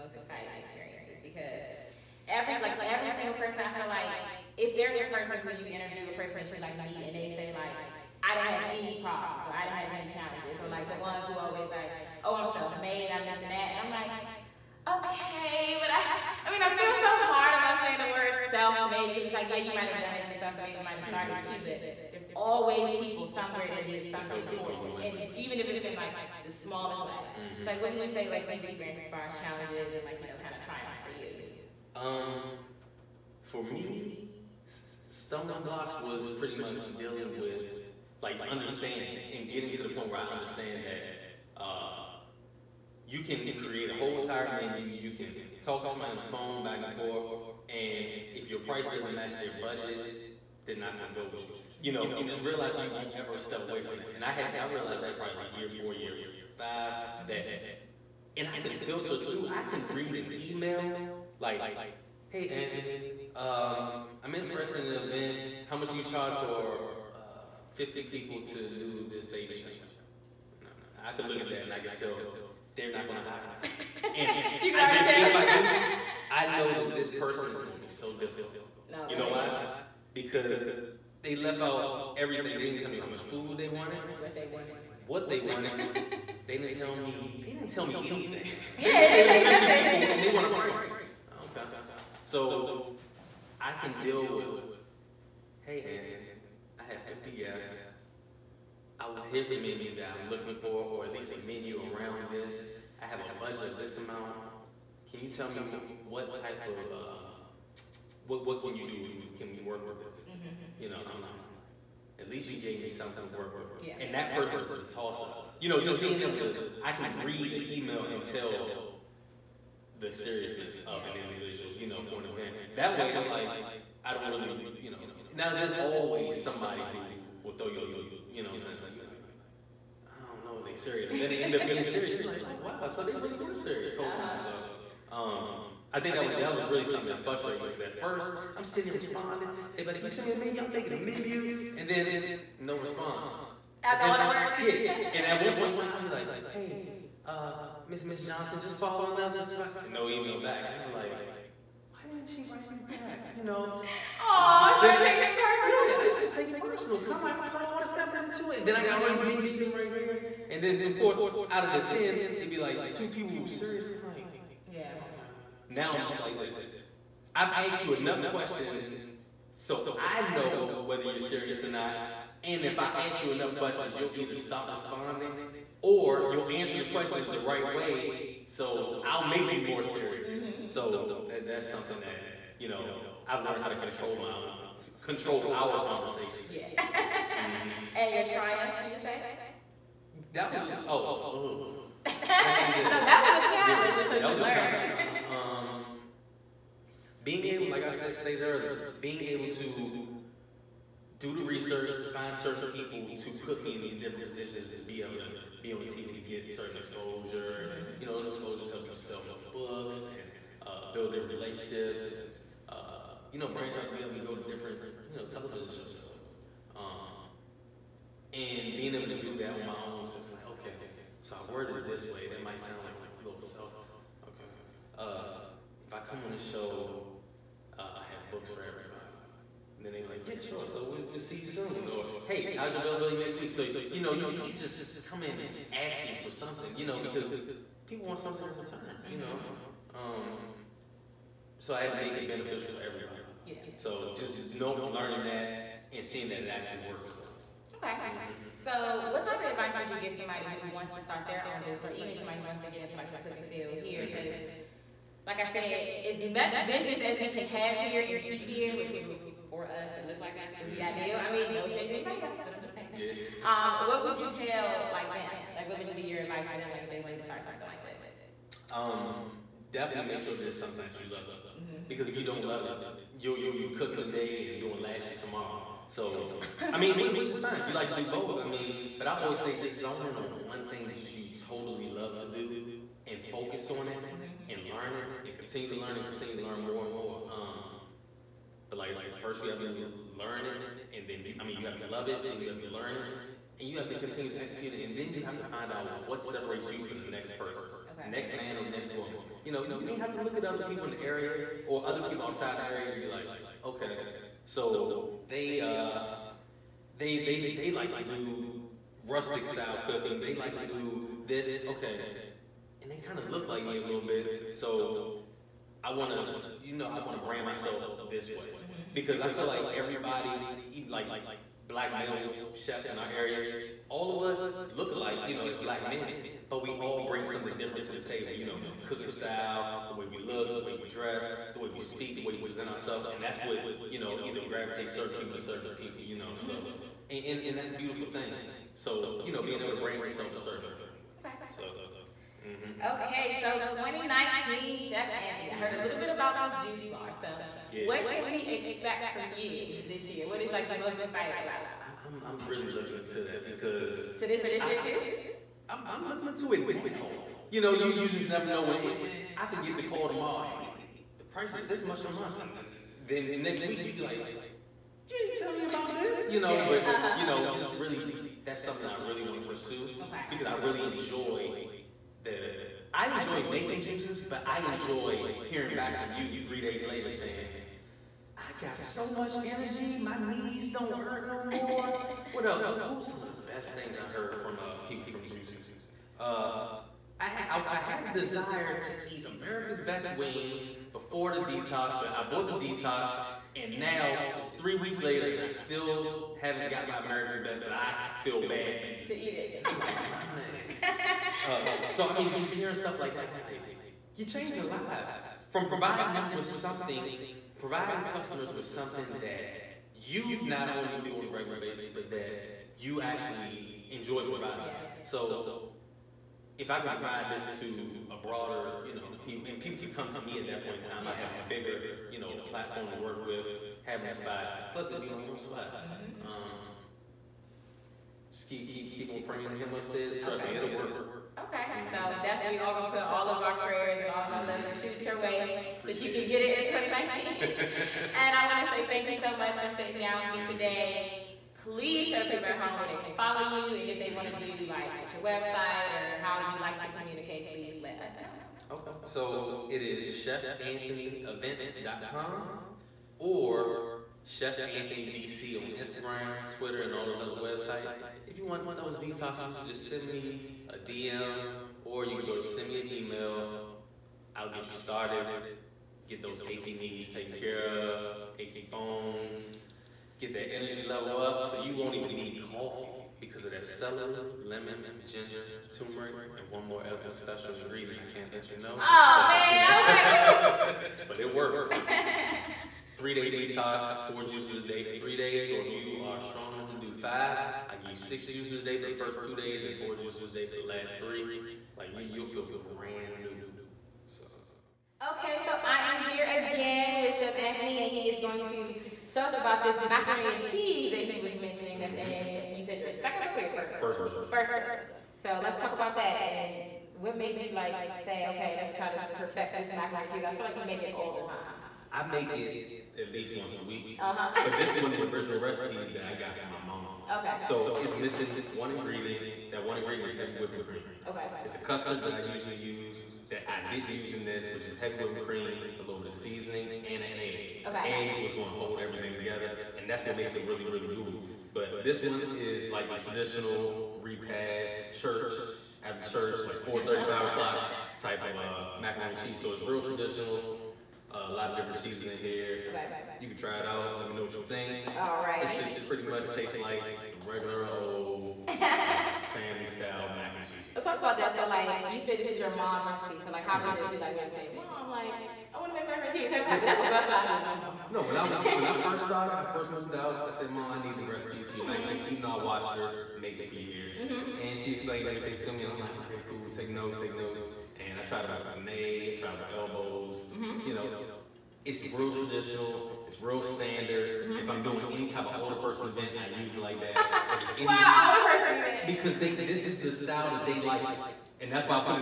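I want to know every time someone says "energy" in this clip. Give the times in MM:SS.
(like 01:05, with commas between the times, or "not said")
06:19, 07:50.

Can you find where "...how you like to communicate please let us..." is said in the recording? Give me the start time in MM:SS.
07:26.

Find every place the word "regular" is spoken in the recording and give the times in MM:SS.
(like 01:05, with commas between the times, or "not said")
06:51, 09:07.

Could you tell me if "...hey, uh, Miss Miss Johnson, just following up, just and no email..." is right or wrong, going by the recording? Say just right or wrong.
right.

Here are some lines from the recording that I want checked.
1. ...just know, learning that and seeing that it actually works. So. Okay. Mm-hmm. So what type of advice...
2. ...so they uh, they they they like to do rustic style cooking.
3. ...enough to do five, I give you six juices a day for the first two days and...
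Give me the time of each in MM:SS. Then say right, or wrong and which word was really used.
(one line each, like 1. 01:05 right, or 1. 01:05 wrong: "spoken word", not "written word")
1. 04:04 right
2. 05:04 right
3. 08:06 right.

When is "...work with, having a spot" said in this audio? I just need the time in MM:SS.
07:02.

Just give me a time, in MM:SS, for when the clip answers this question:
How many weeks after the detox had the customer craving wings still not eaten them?
06:34.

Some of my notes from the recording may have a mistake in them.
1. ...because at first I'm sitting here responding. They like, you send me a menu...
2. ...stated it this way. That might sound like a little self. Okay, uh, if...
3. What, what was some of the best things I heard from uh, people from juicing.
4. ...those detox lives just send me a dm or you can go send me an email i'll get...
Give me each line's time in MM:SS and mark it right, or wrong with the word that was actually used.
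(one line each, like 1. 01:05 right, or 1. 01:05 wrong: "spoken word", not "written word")
1. 02:17 right
2. 03:41 wrong: "worded", not "stated"
3. 06:22 right
4. 07:38 wrong: "juices", not "lives".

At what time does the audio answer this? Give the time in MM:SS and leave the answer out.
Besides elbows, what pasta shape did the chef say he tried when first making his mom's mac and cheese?
09:28.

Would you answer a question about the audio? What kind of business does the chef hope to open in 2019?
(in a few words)
juice bar.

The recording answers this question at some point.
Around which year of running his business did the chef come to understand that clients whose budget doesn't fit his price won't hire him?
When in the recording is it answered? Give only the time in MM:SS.
00:55.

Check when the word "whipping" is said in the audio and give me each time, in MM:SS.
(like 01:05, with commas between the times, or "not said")
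08:40, 08:44.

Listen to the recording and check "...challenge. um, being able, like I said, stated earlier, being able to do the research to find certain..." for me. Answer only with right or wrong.
right.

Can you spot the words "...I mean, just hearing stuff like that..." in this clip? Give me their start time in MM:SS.
06:42.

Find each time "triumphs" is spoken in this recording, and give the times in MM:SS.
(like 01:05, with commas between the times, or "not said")
00:30, 03:08.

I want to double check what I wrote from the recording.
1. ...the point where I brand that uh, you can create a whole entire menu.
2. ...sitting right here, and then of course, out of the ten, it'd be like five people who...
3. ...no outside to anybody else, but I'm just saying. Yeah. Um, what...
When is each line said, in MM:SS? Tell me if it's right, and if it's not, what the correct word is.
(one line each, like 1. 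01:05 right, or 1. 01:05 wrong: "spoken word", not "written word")
1. 00:39 wrong: "understand", not "brand"
2. 02:39 wrong: "two", not "five"
3. 04:21 wrong: "shade", not "outside".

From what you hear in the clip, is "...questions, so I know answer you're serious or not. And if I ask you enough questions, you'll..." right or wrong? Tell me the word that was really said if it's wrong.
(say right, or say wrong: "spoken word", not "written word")
wrong: "whether", not "answer".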